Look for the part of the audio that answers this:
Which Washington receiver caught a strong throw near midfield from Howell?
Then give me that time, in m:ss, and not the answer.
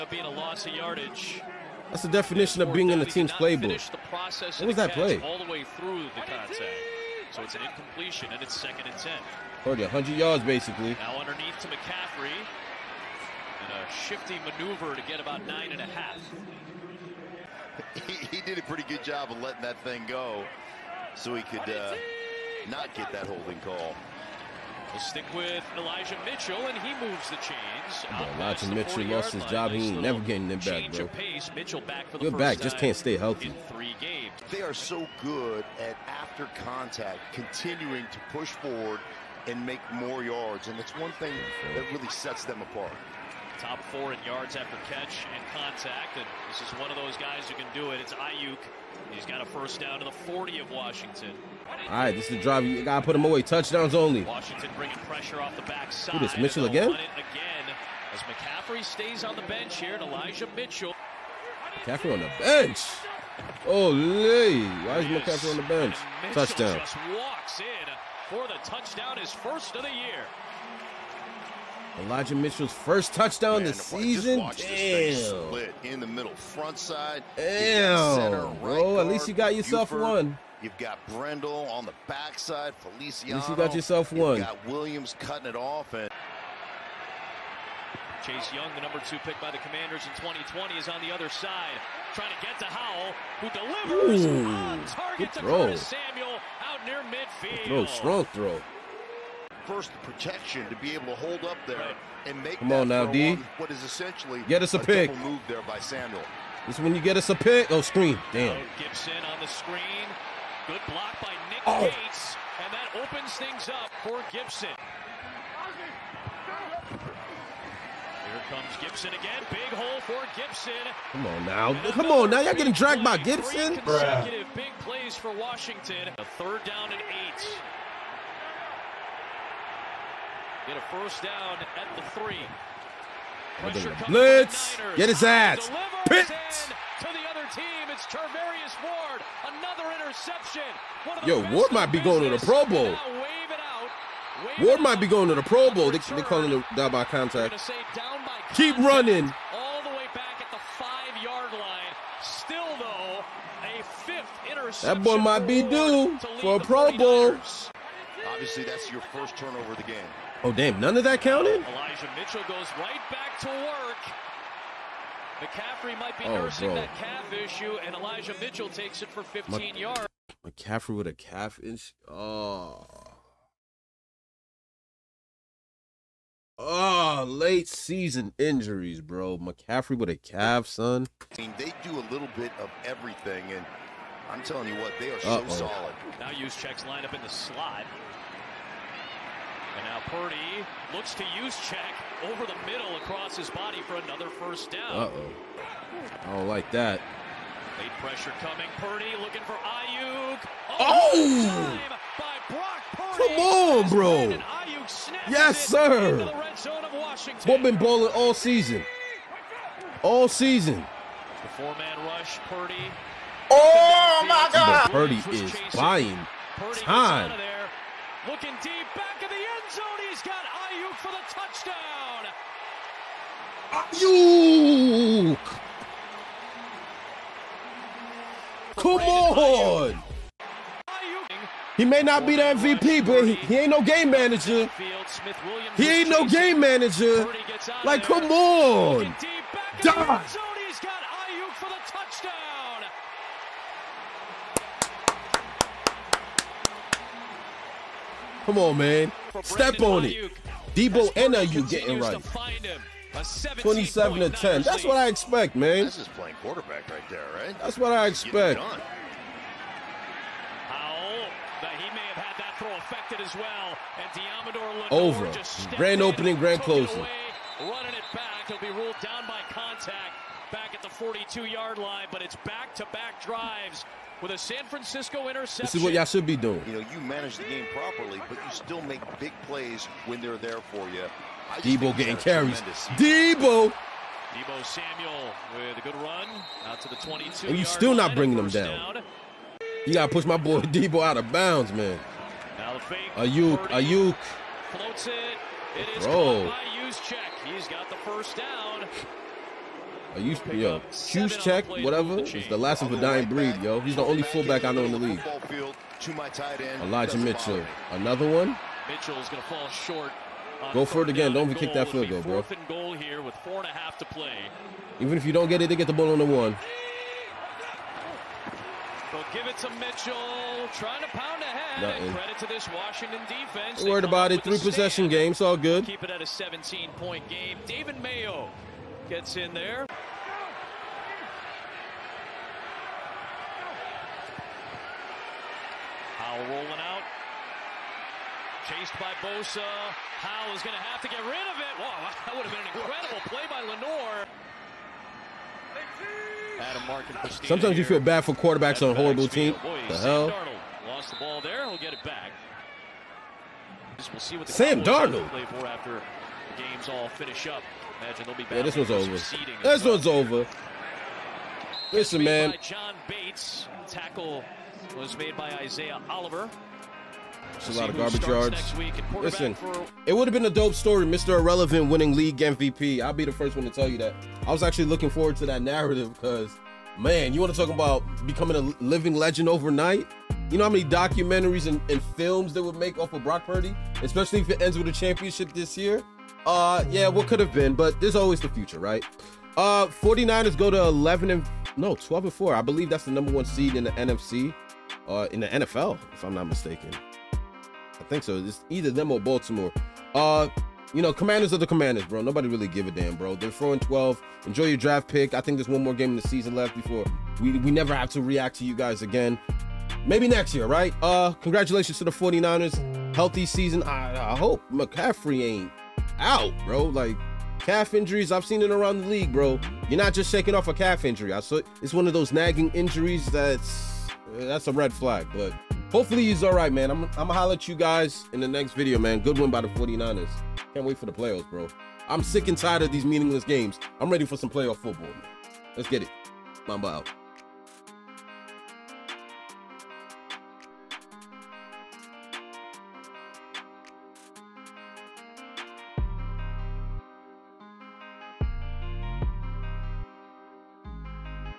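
1:35.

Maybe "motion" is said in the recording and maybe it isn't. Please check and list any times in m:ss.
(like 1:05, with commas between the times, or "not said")
not said.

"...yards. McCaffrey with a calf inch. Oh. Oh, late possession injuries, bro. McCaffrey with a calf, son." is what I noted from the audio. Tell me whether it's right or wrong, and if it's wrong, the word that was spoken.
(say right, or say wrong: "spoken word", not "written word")
wrong: "season", not "possession".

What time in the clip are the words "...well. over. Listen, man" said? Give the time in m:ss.
6:00.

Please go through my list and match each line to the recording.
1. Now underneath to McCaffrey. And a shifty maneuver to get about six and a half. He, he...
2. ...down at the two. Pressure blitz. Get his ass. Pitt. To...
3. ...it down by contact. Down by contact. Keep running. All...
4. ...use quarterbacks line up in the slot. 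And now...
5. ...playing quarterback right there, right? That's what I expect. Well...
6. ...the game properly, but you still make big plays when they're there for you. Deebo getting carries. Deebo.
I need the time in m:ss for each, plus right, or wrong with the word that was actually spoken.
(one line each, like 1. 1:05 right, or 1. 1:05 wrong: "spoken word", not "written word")
1. 0:10 wrong: "nine", not "six"
2. 2:11 wrong: "three", not "two"
3. 2:26 right
4. 3:06 wrong: "checks", not "quarterbacks"
5. 4:16 right
6. 4:37 right.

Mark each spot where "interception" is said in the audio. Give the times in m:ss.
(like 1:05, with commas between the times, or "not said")
2:19, 2:34, 4:35.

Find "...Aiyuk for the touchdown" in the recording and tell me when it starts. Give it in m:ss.
3:40.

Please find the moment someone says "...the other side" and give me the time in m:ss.
1:31.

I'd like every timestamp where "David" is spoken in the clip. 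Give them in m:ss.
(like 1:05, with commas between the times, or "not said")
5:27.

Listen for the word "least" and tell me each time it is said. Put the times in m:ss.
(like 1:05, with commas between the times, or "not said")
1:19, 1:23.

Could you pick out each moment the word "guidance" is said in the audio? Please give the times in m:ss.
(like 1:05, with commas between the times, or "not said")
not said.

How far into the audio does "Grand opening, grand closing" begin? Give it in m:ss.
4:25.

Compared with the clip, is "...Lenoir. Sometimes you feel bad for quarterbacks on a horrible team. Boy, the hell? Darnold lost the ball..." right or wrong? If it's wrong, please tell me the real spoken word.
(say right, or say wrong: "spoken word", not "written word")
right.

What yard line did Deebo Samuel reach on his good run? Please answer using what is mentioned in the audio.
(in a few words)
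22.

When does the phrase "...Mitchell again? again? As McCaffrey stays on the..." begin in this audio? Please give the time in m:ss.
0:56.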